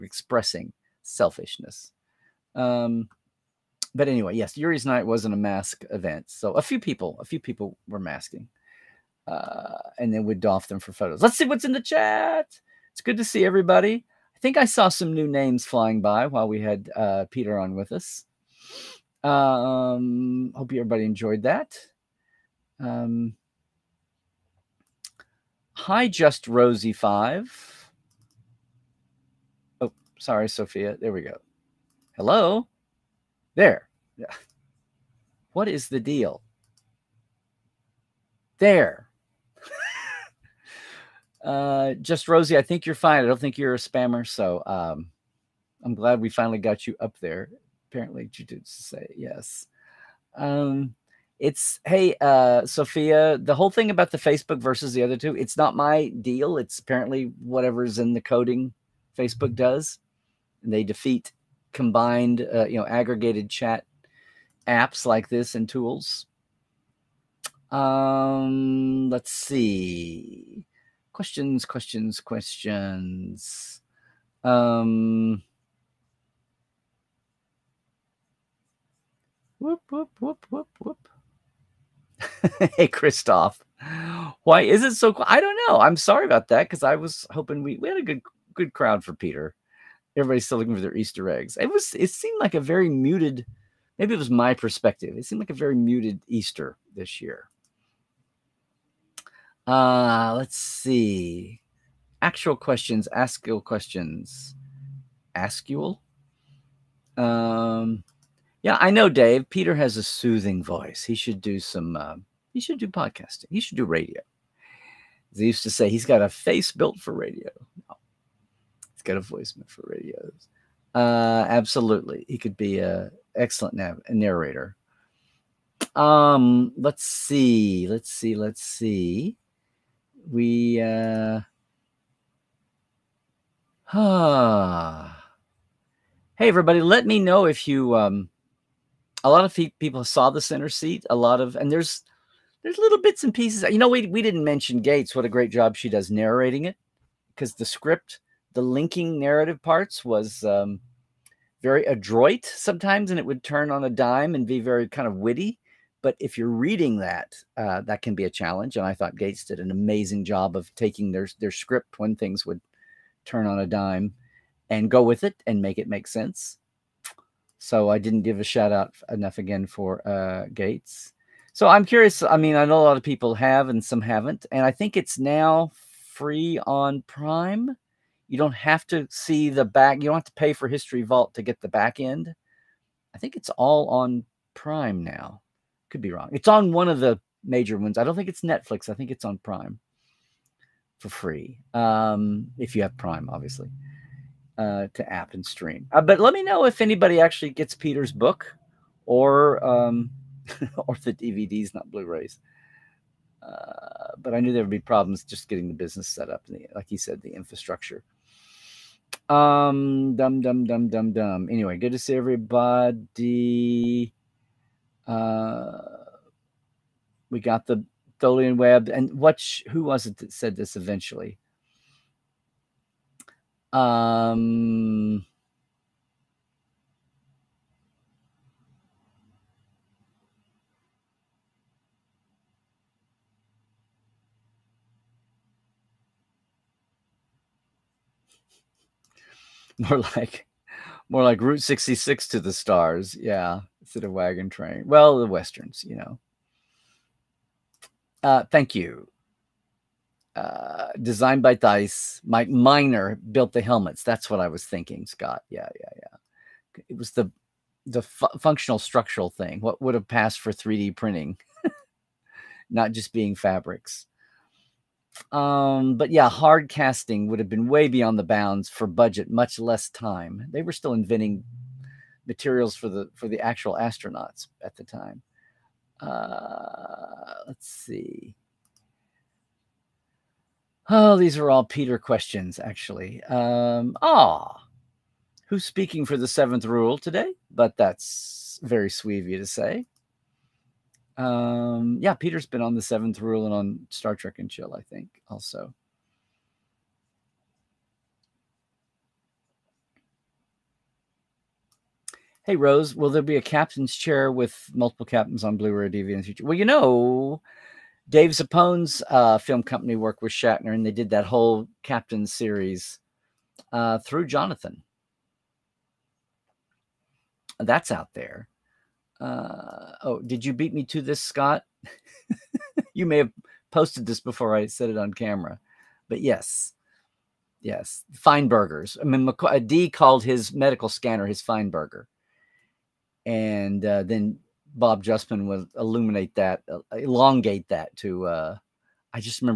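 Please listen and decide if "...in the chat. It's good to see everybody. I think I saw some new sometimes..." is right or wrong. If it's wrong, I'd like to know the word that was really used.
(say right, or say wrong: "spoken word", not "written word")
wrong: "names", not "sometimes".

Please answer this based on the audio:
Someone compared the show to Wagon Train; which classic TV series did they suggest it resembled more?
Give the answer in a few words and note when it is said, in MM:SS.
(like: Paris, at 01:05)
Route 66, at 04:01.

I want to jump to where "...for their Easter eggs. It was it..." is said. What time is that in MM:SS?
01:30.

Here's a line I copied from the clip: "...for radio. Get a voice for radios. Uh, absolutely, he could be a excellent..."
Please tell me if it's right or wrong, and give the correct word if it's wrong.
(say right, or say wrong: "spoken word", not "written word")
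right.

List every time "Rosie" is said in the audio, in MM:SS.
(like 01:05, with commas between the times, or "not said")
00:26, 00:42.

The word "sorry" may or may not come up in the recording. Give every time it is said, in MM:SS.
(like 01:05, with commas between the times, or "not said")
00:30, 01:25.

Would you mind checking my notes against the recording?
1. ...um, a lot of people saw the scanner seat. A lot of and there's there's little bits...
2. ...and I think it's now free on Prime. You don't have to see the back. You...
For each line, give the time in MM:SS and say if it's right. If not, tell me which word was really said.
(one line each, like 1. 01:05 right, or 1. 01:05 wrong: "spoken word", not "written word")
1. 02:17 wrong: "center", not "scanner"
2. 02:54 right.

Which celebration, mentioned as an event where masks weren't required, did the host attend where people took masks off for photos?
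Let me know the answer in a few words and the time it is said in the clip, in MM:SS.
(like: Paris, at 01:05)
Yuri's Night, at 00:04.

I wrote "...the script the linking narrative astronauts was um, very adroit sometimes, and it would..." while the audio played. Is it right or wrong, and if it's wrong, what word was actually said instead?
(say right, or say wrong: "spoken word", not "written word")
wrong: "parts", not "astronauts".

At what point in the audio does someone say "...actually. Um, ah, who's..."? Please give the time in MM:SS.
04:42.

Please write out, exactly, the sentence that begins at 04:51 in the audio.
Um, yeah, Peter's been on the Seventh Rule and on Star Trek and Chill, I think, also.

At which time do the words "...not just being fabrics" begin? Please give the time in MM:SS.
04:22.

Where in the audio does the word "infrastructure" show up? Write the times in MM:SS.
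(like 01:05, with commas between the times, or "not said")
03:27.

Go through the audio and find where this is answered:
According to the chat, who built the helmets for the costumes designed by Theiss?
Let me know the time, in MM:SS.
04:12.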